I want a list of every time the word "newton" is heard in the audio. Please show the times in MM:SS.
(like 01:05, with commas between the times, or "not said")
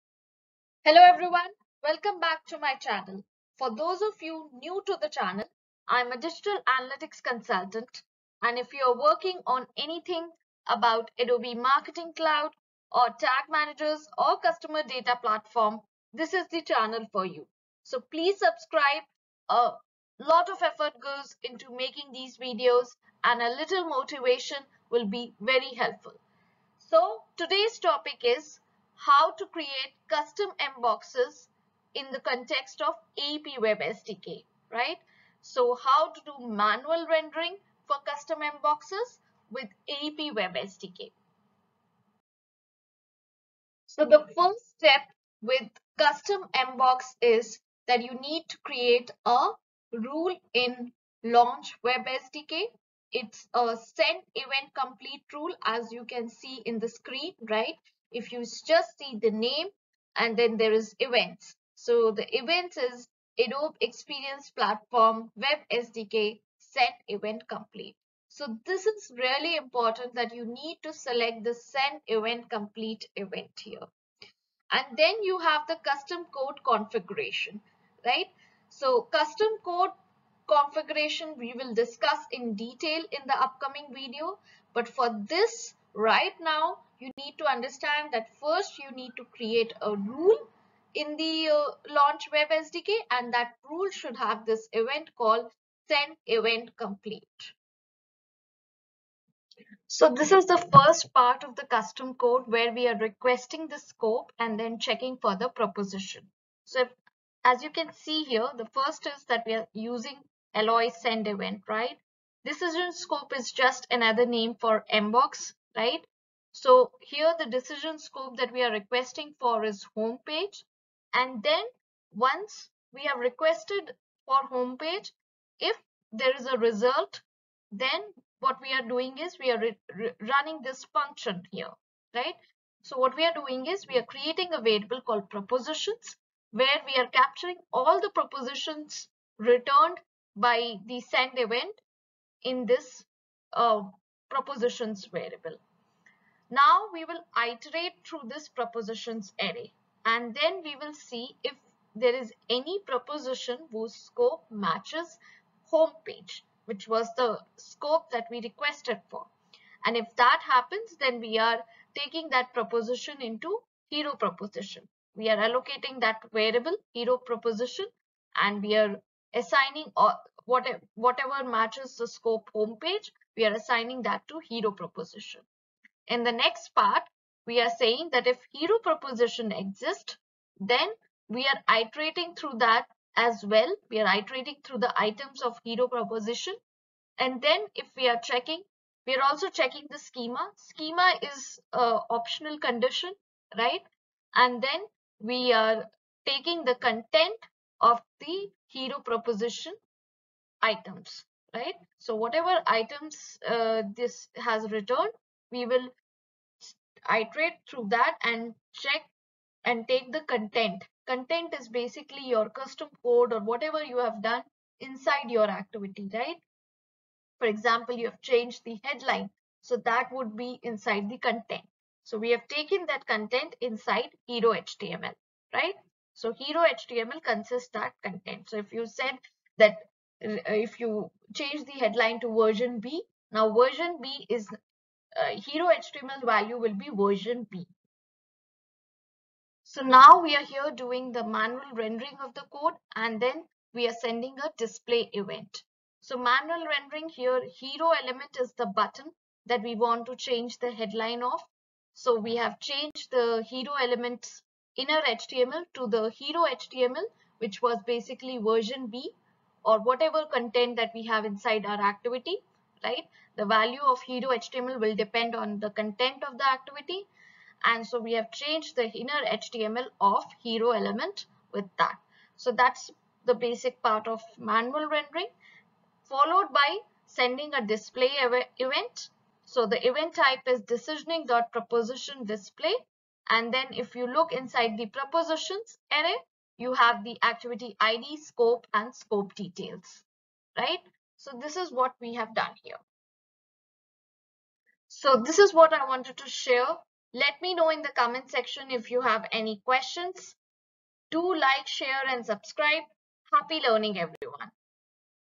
not said.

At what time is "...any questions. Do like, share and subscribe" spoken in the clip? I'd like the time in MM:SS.
04:59.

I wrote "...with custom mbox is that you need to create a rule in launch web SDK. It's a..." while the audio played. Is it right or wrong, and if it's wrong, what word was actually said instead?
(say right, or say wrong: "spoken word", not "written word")
right.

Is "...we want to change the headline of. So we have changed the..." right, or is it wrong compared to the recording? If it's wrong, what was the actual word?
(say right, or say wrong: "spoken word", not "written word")
right.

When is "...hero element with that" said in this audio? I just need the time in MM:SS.
04:30.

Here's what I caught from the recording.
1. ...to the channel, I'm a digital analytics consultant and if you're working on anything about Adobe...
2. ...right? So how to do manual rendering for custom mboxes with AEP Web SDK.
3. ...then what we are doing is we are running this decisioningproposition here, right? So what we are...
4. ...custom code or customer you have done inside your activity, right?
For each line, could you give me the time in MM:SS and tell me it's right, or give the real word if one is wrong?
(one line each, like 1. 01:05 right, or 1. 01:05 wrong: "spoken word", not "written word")
1. 00:04 right
2. 00:34 right
3. 02:07 wrong: "function", not "decisioningproposition"
4. 03:32 wrong: "whatever", not "customer".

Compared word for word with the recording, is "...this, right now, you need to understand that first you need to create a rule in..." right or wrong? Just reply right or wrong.
right.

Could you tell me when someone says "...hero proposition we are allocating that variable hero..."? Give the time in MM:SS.
02:43.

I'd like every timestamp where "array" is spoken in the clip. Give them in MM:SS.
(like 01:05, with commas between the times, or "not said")
02:29, 04:45.